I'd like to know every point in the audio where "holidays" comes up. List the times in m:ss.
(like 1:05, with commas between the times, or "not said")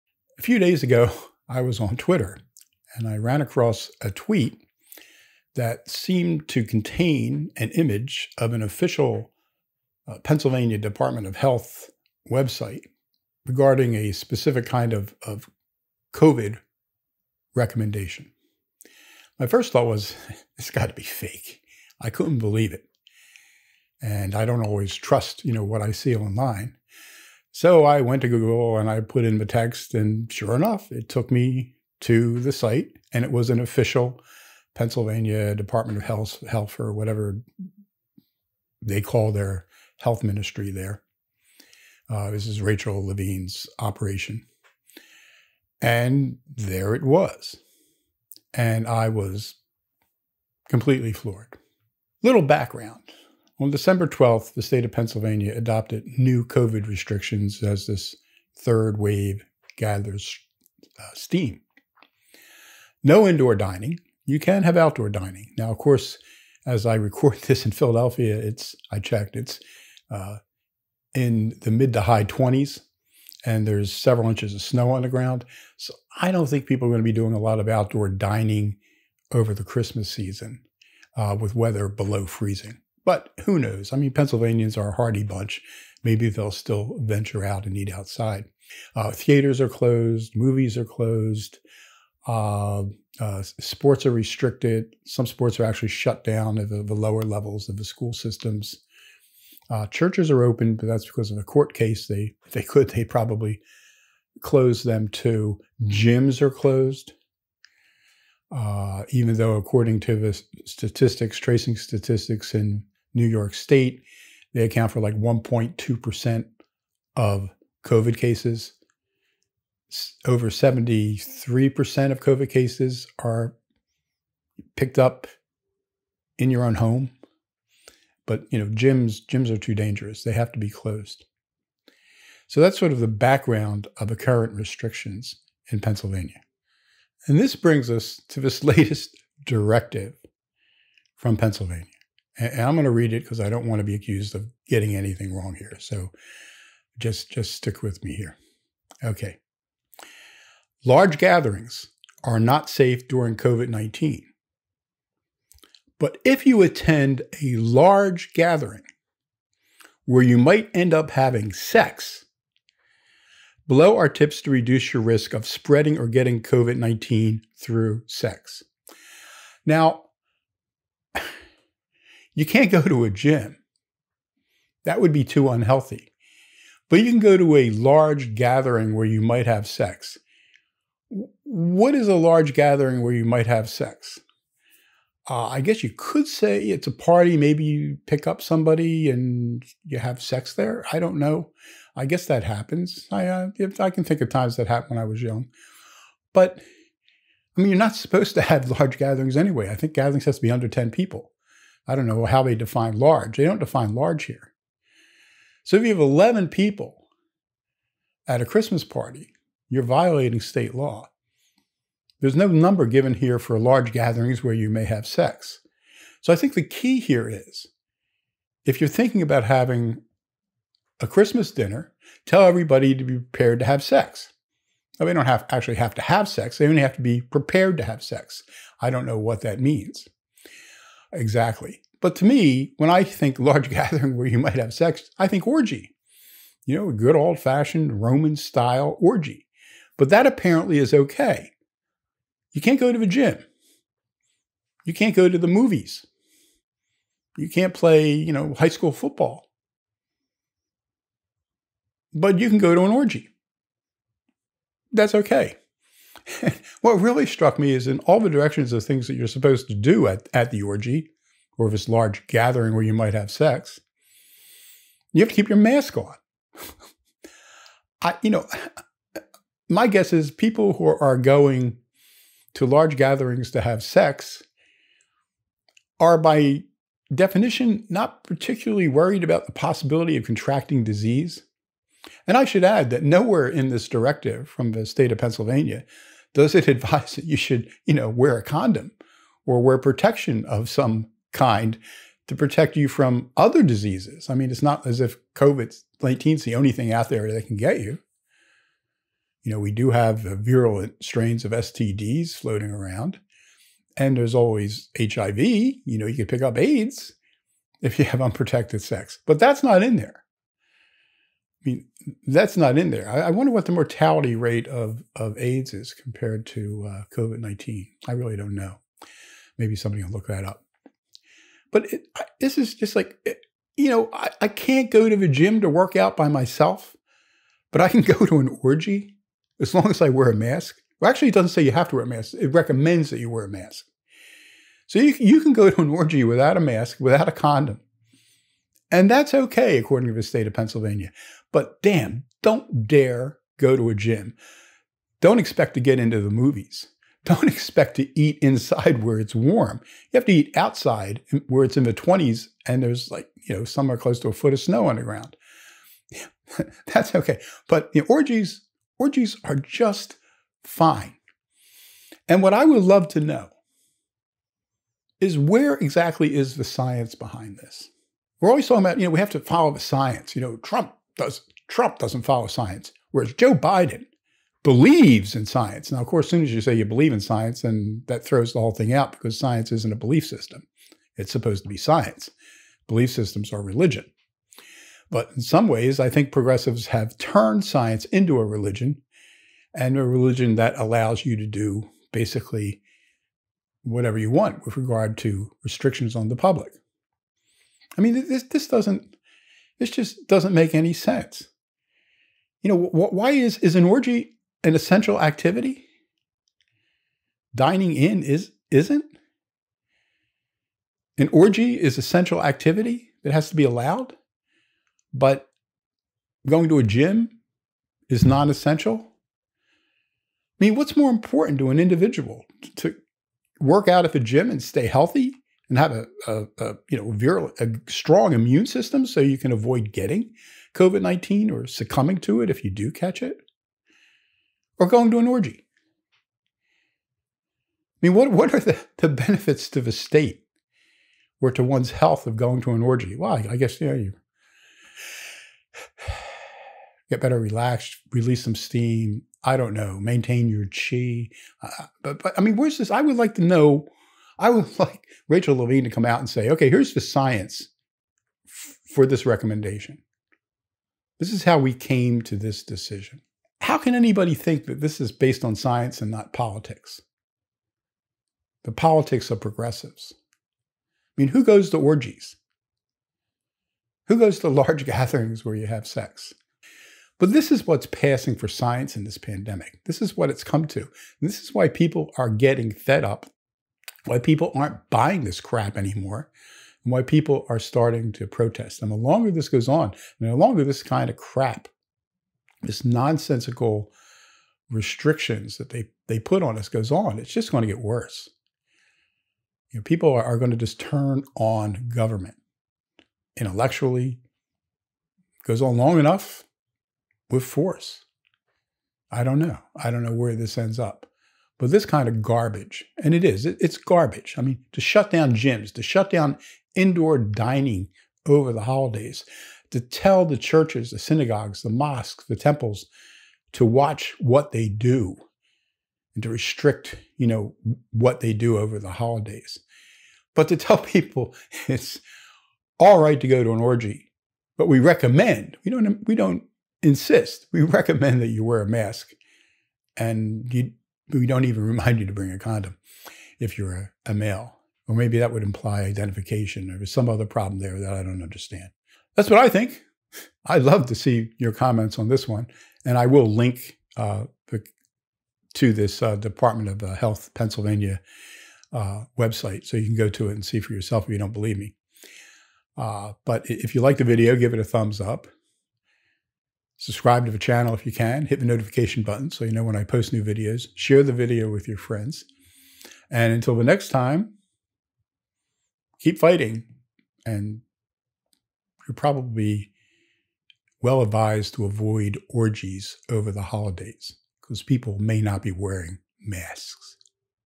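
8:38, 8:48, 9:43.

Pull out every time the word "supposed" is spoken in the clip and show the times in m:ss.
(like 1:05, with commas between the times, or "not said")
3:17, 4:19, 6:21.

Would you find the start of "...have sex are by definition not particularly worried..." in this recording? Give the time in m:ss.
4:33.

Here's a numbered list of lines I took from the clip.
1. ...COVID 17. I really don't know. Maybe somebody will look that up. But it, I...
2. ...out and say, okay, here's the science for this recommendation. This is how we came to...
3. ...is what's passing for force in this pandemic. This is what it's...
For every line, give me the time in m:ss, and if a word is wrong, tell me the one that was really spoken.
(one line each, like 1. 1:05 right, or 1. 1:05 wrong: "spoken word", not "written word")
1. 5:17 wrong: "19", not "17"
2. 7:36 right
3. 7:57 wrong: "science", not "force".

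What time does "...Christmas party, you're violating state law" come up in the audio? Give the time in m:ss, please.
3:28.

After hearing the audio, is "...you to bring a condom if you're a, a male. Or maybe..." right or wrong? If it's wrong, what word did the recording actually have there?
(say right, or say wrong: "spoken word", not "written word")
right.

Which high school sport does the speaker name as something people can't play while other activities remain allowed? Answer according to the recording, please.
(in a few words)
football.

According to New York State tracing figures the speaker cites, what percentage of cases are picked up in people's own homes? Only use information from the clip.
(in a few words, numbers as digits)
over 73%.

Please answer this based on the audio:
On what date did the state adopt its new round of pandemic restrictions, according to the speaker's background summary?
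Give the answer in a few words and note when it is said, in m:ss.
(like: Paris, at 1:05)
December 12th, at 0:53.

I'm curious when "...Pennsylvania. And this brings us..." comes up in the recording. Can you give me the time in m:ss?
2:15.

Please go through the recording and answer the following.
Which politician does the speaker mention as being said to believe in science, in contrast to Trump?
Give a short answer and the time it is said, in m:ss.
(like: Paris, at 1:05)
Joe Biden, at 6:13.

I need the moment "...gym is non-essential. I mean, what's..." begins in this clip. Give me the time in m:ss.
6:56.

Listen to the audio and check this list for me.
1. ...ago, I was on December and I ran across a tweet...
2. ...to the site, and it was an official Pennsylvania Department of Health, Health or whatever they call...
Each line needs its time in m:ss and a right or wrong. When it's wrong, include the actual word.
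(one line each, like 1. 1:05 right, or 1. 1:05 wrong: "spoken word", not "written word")
1. 0:00 wrong: "Twitter", not "December"
2. 0:32 right.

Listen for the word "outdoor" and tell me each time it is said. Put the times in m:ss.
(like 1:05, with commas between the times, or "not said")
1:04, 1:17.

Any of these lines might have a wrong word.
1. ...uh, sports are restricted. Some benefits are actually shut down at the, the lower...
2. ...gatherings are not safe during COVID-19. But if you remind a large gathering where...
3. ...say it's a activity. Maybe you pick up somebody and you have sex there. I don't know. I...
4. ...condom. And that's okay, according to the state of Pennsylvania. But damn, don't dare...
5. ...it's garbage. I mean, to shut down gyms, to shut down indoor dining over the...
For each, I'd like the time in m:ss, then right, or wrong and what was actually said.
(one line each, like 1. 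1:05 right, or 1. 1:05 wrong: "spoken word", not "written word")
1. 1:33 wrong: "sports", not "benefits"
2. 2:31 wrong: "attend", not "remind"
3. 3:06 wrong: "party", not "activity"
4. 5:37 right
5. 8:33 right.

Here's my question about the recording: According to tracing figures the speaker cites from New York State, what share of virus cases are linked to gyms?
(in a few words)
1.2%.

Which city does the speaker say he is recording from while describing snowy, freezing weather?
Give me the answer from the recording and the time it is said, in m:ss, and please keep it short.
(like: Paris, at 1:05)
Philadelphia, at 1:07.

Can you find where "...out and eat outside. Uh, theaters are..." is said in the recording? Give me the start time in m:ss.
1:27.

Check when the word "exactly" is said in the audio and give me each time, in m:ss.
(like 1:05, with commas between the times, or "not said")
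3:51, 6:05.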